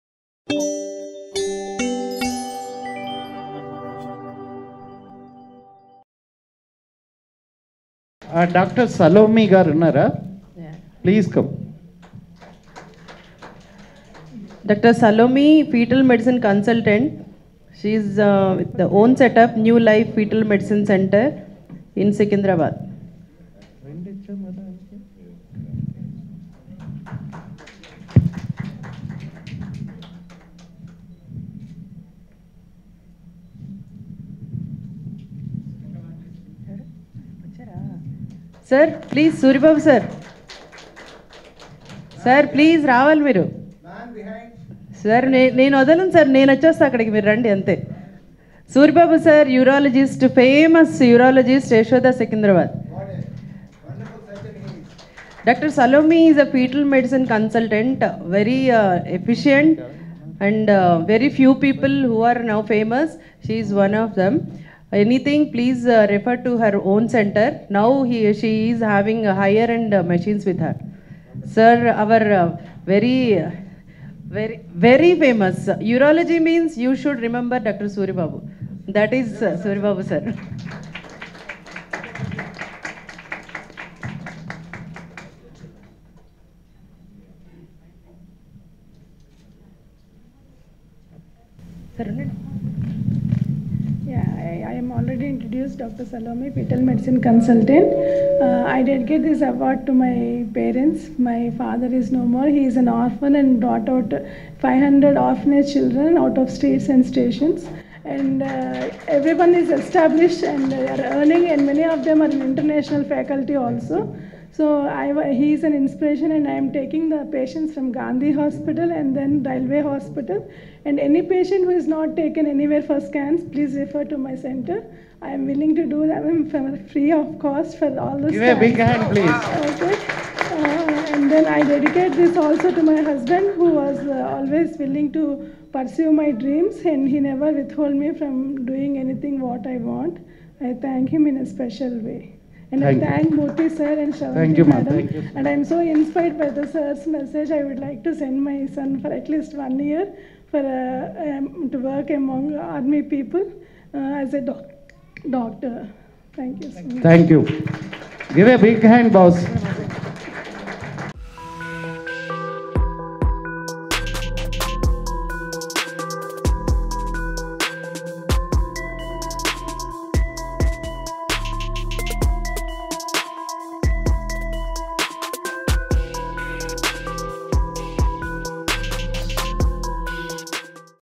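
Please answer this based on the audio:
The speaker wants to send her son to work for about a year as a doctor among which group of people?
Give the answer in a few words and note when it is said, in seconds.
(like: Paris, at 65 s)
army people, at 152 s.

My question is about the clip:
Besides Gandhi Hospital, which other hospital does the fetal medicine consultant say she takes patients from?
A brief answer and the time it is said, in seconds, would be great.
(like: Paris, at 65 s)
Railway Hospital, at 119 s.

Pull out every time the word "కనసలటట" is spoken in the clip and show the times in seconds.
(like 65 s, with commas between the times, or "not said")
16 s, 57 s.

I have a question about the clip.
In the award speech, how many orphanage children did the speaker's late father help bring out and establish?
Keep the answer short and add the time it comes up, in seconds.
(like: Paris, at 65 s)
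500, at 104 s.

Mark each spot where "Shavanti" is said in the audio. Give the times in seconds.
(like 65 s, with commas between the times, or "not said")
144 s.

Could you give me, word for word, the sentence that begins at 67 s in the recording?
Now he, she is having higher-end uh, machines with her.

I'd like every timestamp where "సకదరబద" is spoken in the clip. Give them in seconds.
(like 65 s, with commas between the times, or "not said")
22 s, 52 s.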